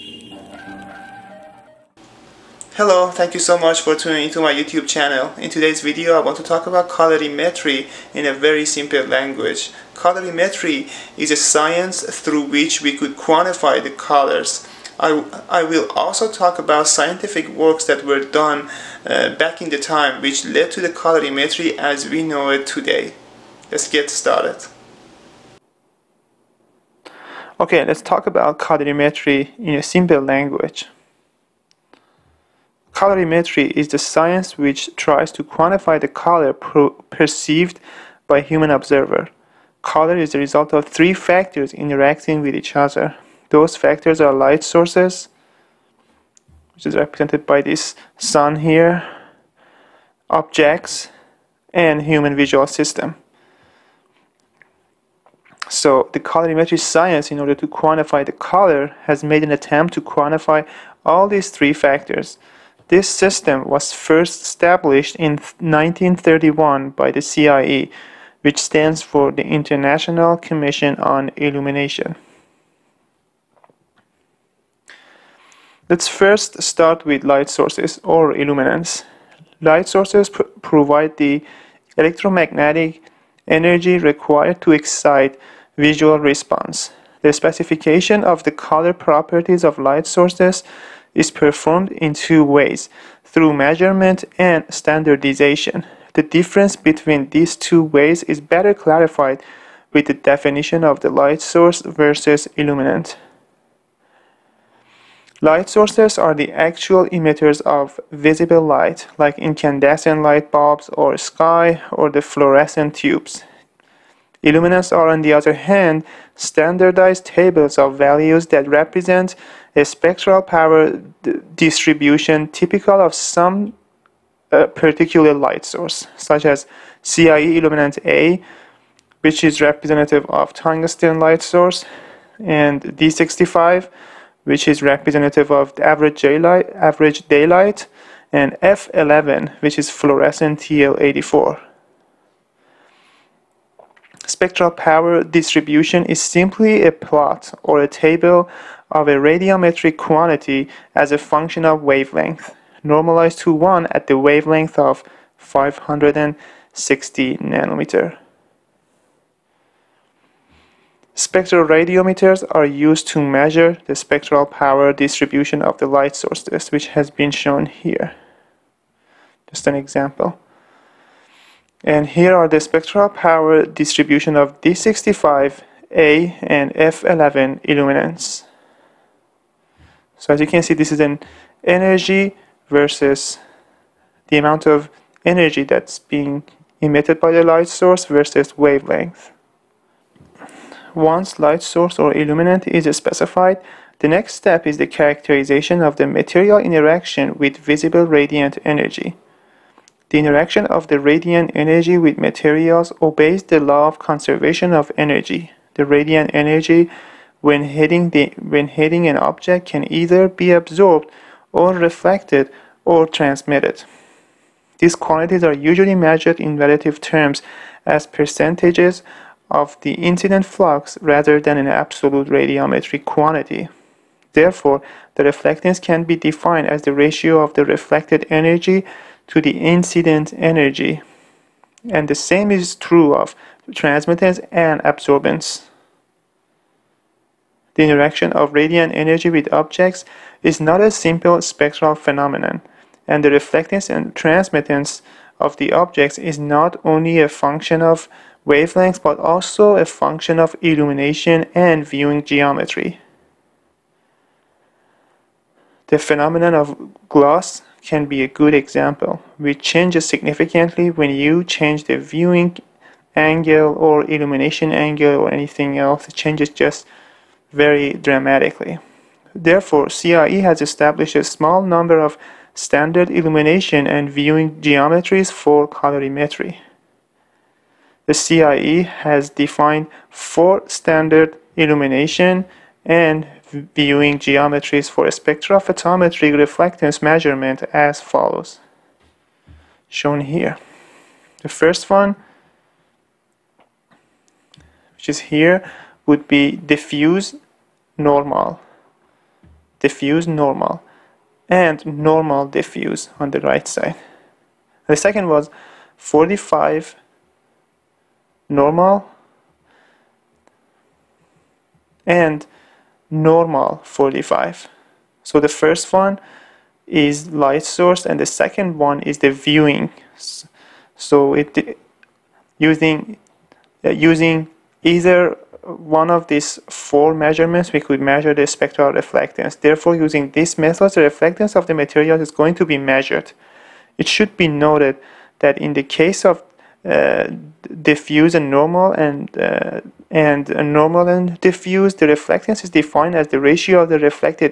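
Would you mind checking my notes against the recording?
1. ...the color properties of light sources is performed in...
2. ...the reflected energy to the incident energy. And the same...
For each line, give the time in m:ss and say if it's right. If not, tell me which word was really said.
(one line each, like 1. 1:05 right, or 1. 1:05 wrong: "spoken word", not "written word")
1. 1:28 right
2. 3:47 right.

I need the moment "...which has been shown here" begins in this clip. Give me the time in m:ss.
2:46.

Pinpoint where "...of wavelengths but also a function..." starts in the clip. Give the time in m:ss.
4:07.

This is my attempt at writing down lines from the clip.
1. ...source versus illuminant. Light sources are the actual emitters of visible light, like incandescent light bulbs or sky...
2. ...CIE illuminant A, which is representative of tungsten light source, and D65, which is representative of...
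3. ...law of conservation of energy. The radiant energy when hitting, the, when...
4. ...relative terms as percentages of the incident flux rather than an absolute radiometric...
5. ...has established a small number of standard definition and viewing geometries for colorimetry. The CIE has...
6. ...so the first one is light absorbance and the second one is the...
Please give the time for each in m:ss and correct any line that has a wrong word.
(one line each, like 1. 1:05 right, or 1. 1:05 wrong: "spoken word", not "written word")
1. 1:41 right
2. 2:07 right
3. 3:23 right
4. 3:36 right
5. 4:30 wrong: "illumination", not "definition"
6. 5:15 wrong: "source", not "absorbance".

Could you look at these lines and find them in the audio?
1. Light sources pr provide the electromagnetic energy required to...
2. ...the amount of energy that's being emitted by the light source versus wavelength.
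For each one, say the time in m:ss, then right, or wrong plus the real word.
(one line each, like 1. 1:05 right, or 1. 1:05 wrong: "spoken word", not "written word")
1. 1:19 right
2. 3:04 right.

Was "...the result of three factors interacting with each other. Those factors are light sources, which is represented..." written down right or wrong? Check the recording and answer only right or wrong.
right.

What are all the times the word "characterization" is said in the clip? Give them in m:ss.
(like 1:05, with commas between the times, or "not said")
3:14.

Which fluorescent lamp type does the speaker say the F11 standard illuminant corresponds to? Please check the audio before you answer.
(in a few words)
TL84.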